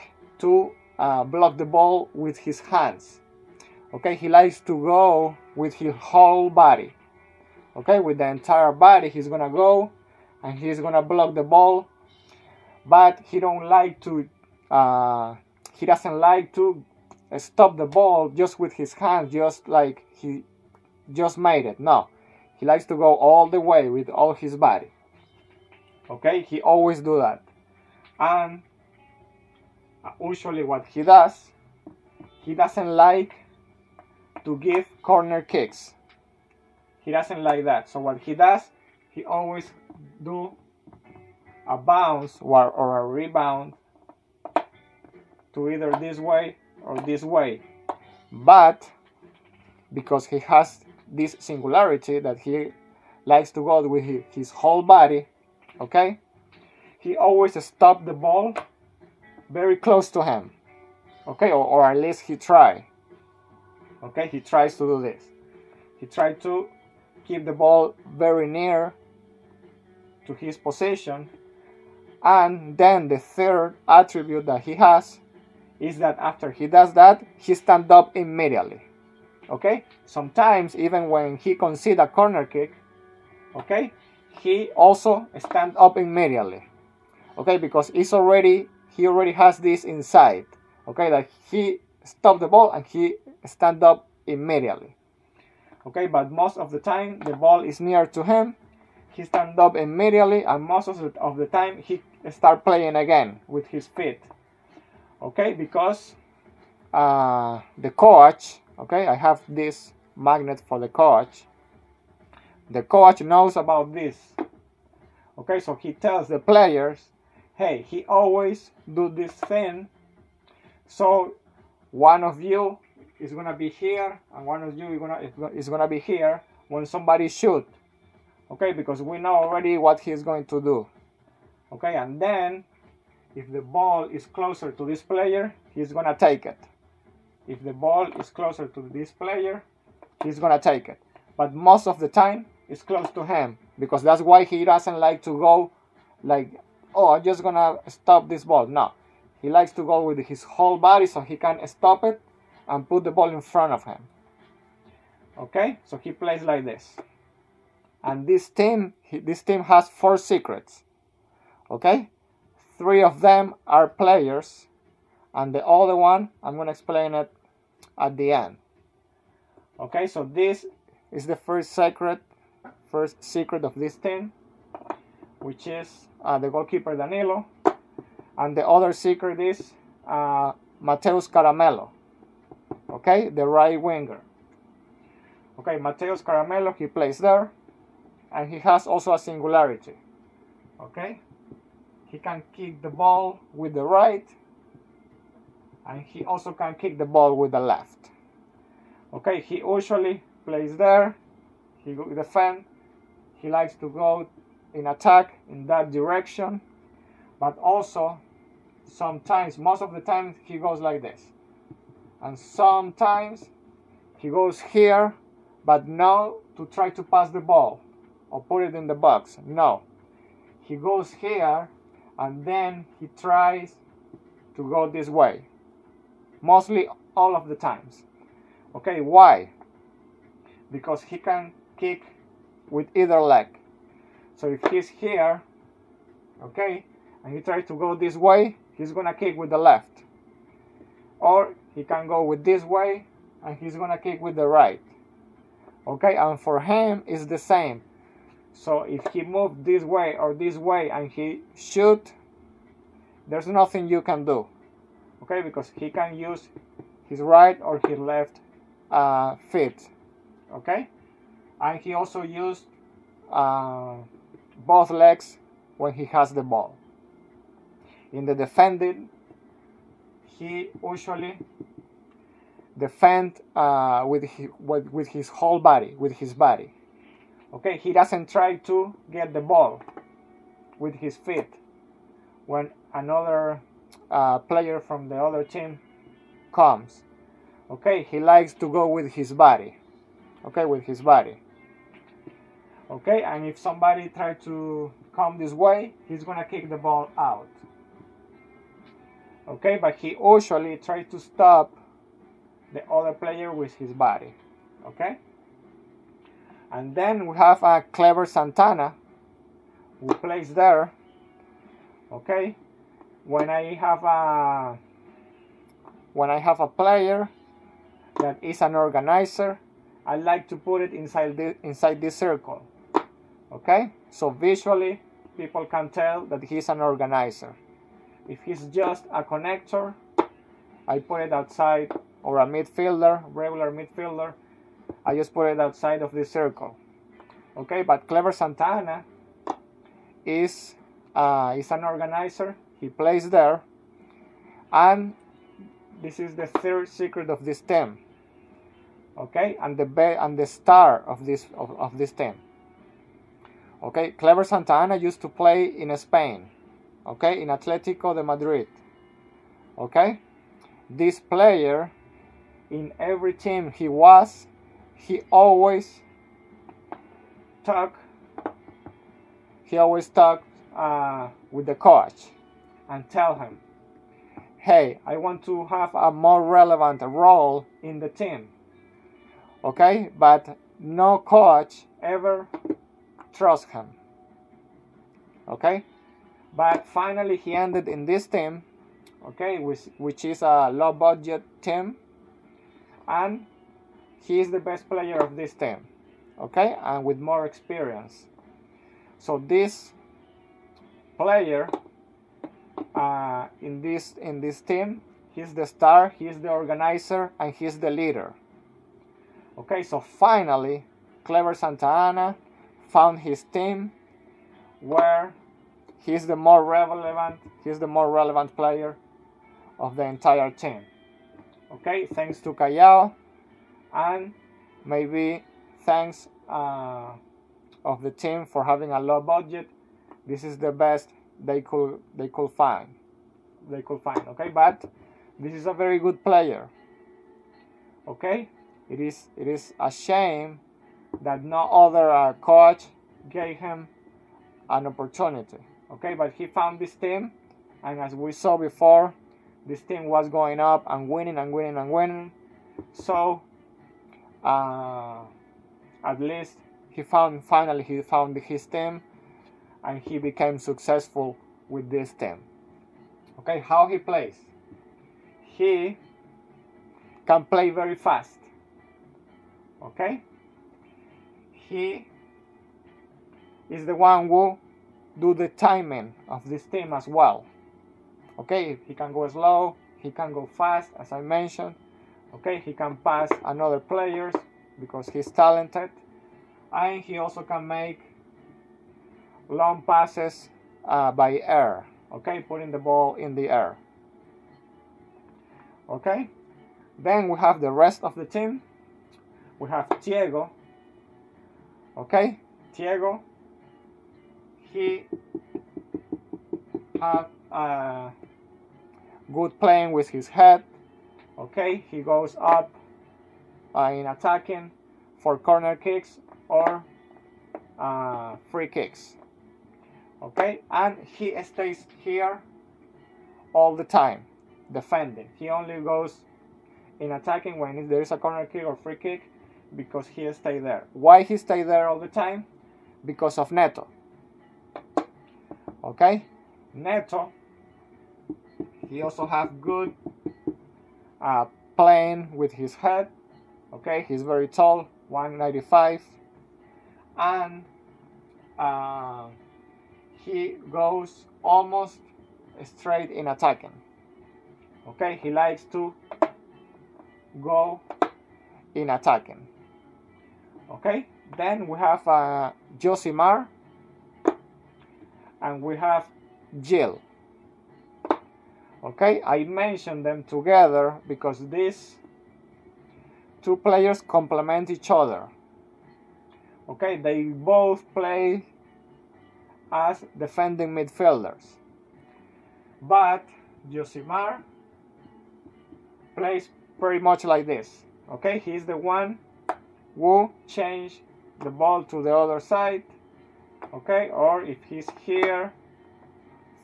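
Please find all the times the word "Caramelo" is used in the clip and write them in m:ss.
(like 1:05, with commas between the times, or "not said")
3:01, 3:06.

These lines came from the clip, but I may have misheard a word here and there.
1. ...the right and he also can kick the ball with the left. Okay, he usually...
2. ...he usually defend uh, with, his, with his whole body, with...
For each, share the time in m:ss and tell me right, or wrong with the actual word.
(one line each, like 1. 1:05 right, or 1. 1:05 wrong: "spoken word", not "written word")
1. 3:13 right
2. 4:30 right.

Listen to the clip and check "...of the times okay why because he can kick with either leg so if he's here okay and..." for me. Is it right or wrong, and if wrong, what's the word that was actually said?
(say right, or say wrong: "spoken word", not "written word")
right.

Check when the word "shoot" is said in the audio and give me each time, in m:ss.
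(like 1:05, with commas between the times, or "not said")
2:07, 4:11.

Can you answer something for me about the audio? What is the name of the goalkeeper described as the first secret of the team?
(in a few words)
Danilo.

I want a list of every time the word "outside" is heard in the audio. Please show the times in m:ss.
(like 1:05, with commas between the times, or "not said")
5:31, 5:35.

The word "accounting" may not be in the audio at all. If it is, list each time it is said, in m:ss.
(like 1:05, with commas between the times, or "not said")
not said.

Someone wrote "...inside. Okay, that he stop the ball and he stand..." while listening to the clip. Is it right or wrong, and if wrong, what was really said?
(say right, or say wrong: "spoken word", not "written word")
right.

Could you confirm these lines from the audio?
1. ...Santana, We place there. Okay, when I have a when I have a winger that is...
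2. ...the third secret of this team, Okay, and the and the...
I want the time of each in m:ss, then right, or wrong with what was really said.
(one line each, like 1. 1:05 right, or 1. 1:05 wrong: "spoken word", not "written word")
1. 5:08 wrong: "player", not "winger"
2. 5:46 right.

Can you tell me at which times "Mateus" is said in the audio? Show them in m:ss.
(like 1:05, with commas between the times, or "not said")
3:00, 3:05.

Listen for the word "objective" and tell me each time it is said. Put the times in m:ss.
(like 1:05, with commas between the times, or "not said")
not said.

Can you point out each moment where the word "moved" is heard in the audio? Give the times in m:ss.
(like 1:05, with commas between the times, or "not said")
4:09.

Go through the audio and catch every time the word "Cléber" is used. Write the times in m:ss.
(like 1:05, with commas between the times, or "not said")
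5:07, 5:38, 5:54, 6:51.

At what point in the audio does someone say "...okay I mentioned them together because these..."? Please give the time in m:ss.
9:28.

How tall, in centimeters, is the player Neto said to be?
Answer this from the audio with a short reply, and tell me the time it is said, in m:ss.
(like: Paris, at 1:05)
195, at 9:05.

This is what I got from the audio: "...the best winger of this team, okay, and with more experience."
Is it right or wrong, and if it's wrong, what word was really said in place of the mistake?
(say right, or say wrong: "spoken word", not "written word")
wrong: "player", not "winger".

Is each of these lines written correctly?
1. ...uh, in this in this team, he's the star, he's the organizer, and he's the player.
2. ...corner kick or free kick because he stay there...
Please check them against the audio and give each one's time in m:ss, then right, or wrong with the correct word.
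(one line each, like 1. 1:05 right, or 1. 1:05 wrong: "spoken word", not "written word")
1. 6:42 wrong: "leader", not "player"
2. 8:48 right.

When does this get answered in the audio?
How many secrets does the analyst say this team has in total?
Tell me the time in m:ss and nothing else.
2:39.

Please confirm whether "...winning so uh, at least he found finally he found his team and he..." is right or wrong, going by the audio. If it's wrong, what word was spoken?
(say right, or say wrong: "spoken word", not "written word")
right.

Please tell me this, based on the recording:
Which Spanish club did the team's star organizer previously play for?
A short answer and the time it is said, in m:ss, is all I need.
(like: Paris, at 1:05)
Atletico de Madrid, at 5:57.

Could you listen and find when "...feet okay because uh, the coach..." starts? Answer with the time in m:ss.
1:43.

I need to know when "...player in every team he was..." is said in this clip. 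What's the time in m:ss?
6:01.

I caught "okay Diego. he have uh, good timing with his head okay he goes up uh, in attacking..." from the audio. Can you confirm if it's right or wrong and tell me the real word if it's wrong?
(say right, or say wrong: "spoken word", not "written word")
wrong: "playing", not "timing".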